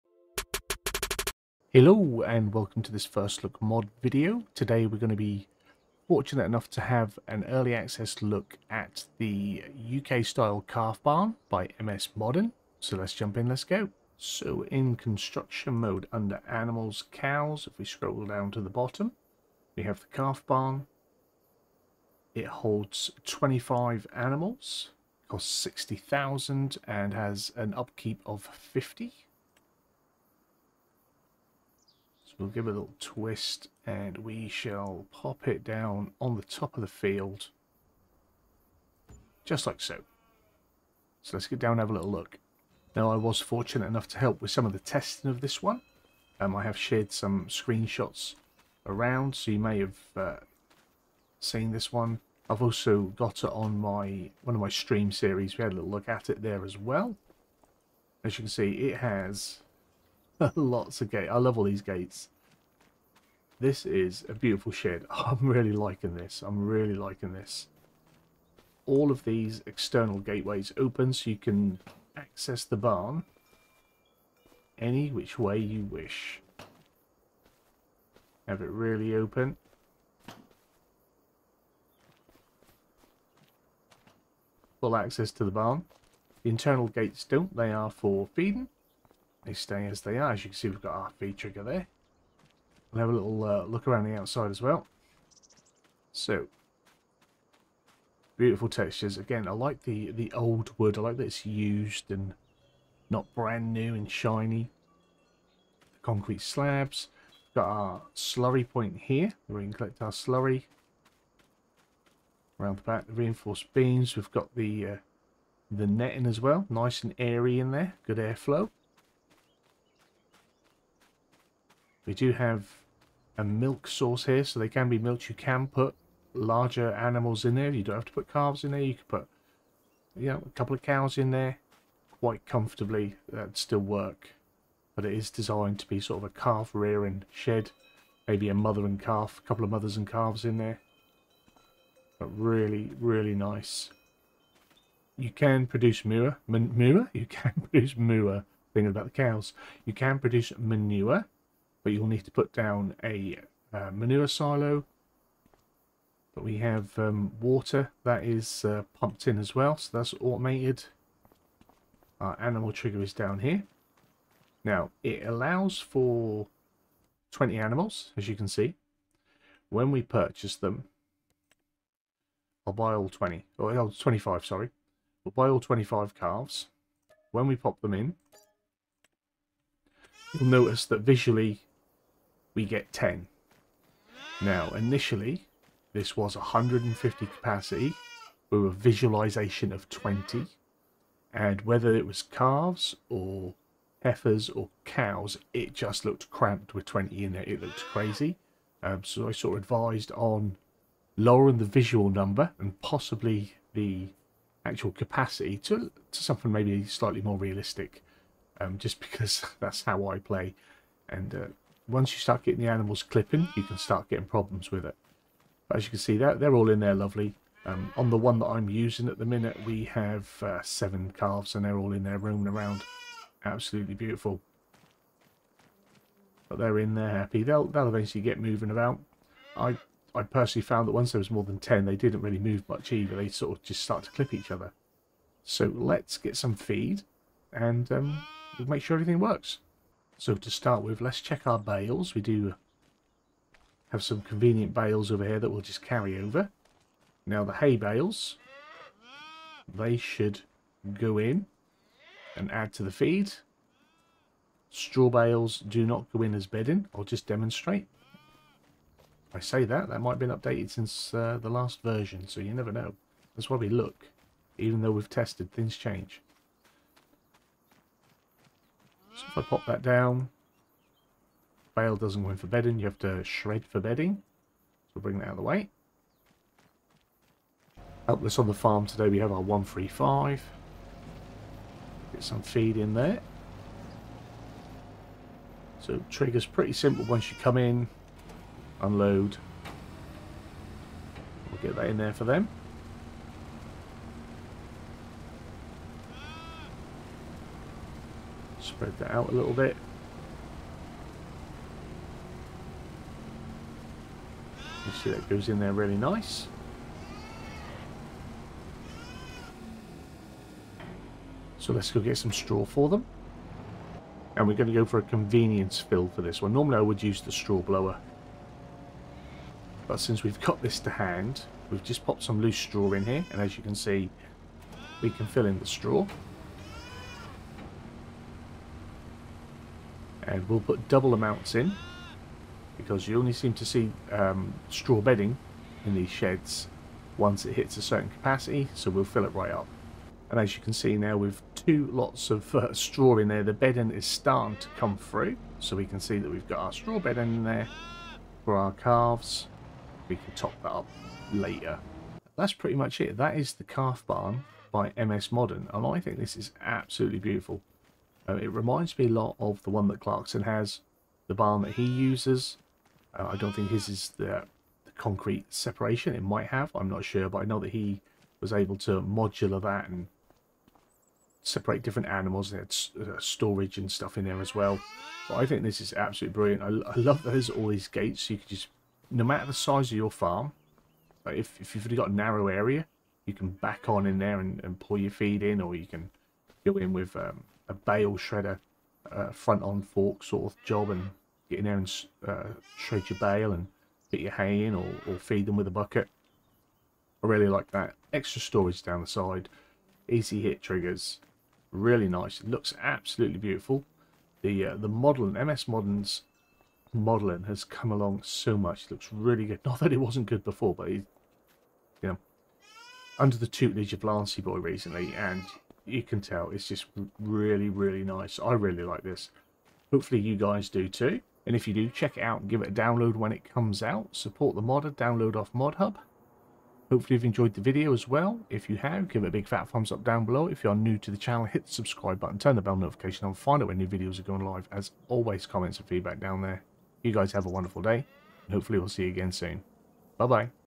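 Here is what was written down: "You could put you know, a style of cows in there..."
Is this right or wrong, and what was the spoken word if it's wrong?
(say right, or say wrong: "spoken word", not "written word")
wrong: "couple", not "style".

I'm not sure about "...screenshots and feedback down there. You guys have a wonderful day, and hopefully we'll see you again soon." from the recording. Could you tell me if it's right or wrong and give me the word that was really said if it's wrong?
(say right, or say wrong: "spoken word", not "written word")
wrong: "comments", not "screenshots".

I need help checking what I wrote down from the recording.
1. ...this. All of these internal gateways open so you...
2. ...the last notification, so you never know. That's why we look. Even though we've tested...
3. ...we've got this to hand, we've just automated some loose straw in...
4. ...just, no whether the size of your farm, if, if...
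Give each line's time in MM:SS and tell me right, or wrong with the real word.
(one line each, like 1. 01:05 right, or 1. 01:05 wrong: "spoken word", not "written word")
1. 01:07 wrong: "external", not "internal"
2. 04:21 wrong: "version", not "notification"
3. 05:20 wrong: "popped", not "automated"
4. 06:18 wrong: "matter", not "whether".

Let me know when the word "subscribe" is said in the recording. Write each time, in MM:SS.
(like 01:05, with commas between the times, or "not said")
07:11.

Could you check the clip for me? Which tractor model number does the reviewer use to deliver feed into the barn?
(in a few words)
135.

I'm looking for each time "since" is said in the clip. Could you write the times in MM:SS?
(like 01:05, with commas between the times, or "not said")
04:20, 05:19.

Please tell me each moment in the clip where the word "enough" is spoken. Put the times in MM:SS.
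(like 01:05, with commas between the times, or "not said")
00:06, 00:43.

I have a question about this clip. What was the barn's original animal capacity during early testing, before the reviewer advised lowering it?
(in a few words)
150.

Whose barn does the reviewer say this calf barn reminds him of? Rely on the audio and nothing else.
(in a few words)
Clarkson.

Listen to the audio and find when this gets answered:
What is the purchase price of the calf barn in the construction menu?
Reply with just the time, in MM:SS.
00:25.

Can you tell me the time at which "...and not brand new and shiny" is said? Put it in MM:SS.
01:42.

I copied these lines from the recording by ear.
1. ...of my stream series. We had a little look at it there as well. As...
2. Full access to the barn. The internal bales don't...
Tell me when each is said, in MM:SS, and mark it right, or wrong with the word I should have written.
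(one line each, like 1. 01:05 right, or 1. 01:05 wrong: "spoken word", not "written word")
1. 00:54 right
2. 01:24 wrong: "gates", not "bales".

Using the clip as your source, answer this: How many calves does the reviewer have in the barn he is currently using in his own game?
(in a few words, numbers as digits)
7.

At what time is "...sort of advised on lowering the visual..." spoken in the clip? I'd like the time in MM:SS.
03:19.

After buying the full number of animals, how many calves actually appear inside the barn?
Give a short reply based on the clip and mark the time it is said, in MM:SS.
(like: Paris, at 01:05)
10, at 03:02.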